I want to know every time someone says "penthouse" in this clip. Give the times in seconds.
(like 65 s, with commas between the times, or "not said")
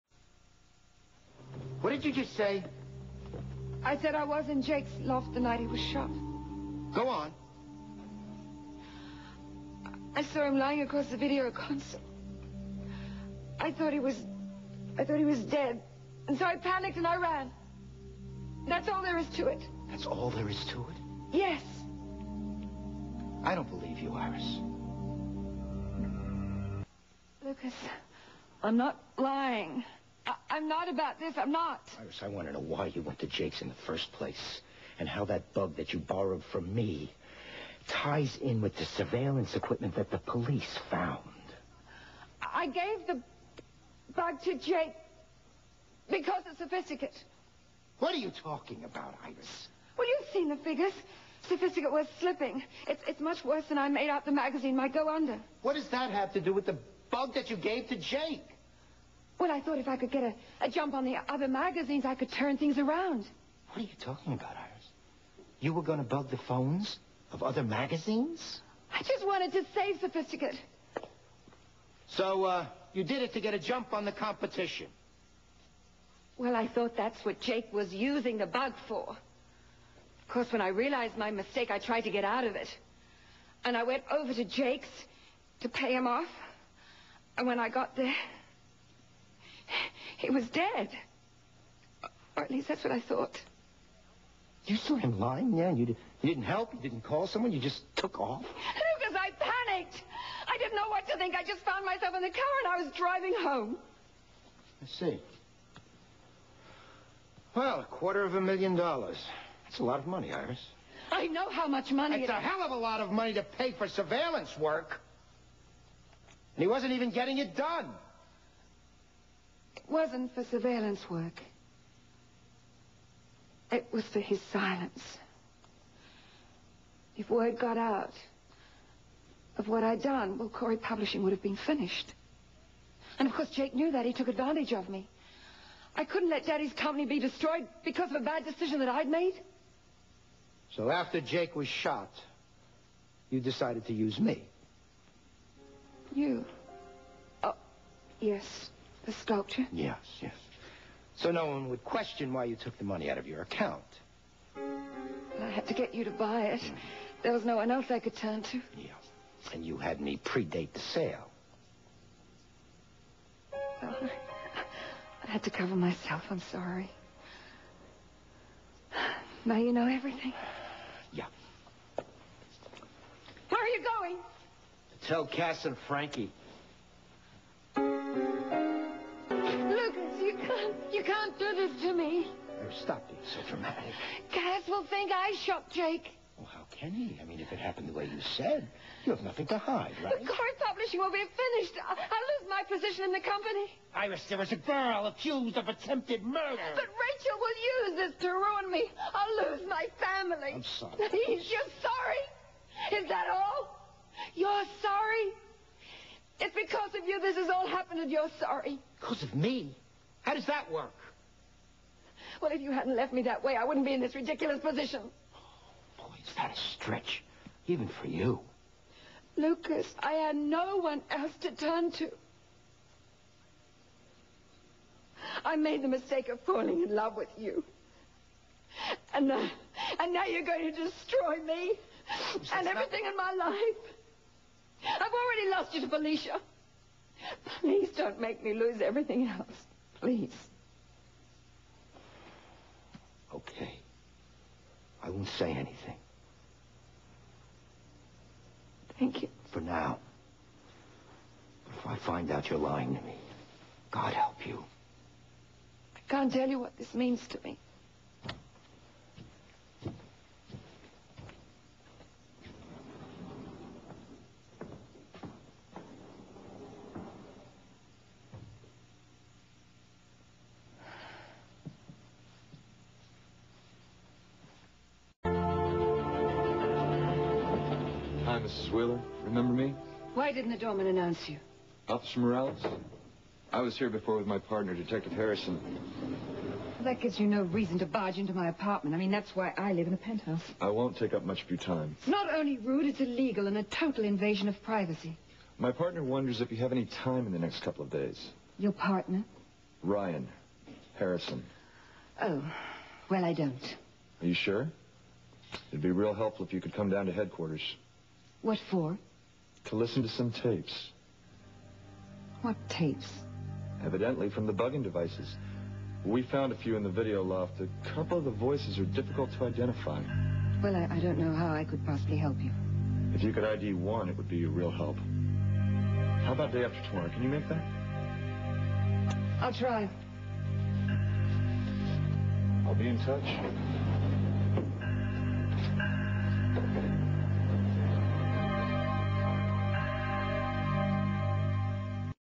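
289 s.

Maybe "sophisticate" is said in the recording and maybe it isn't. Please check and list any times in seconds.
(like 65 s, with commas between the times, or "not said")
46 s, 51 s, 69 s.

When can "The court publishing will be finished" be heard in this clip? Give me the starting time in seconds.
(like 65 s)
190 s.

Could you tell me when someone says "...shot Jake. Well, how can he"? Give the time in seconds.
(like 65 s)
185 s.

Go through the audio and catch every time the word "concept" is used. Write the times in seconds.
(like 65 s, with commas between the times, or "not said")
not said.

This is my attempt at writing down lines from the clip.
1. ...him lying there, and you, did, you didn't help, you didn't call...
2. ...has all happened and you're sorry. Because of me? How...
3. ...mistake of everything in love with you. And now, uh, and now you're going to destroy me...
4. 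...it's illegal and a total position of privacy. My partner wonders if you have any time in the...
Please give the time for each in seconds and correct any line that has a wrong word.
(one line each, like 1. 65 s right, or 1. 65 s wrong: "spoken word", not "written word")
1. 94 s right
2. 207 s right
3. 225 s wrong: "falling", not "everything"
4. 292 s wrong: "invasion", not "position".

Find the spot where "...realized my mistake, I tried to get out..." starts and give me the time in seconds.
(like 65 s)
80 s.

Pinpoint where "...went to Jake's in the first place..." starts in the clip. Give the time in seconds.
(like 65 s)
33 s.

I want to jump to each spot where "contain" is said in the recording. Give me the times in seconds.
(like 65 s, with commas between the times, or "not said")
not said.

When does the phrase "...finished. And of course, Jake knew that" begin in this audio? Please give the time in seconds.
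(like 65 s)
131 s.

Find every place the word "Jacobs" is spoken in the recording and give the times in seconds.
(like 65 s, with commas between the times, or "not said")
not said.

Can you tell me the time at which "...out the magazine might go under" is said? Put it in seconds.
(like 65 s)
54 s.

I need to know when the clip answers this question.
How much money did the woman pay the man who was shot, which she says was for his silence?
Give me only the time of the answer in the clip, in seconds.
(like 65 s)
107 s.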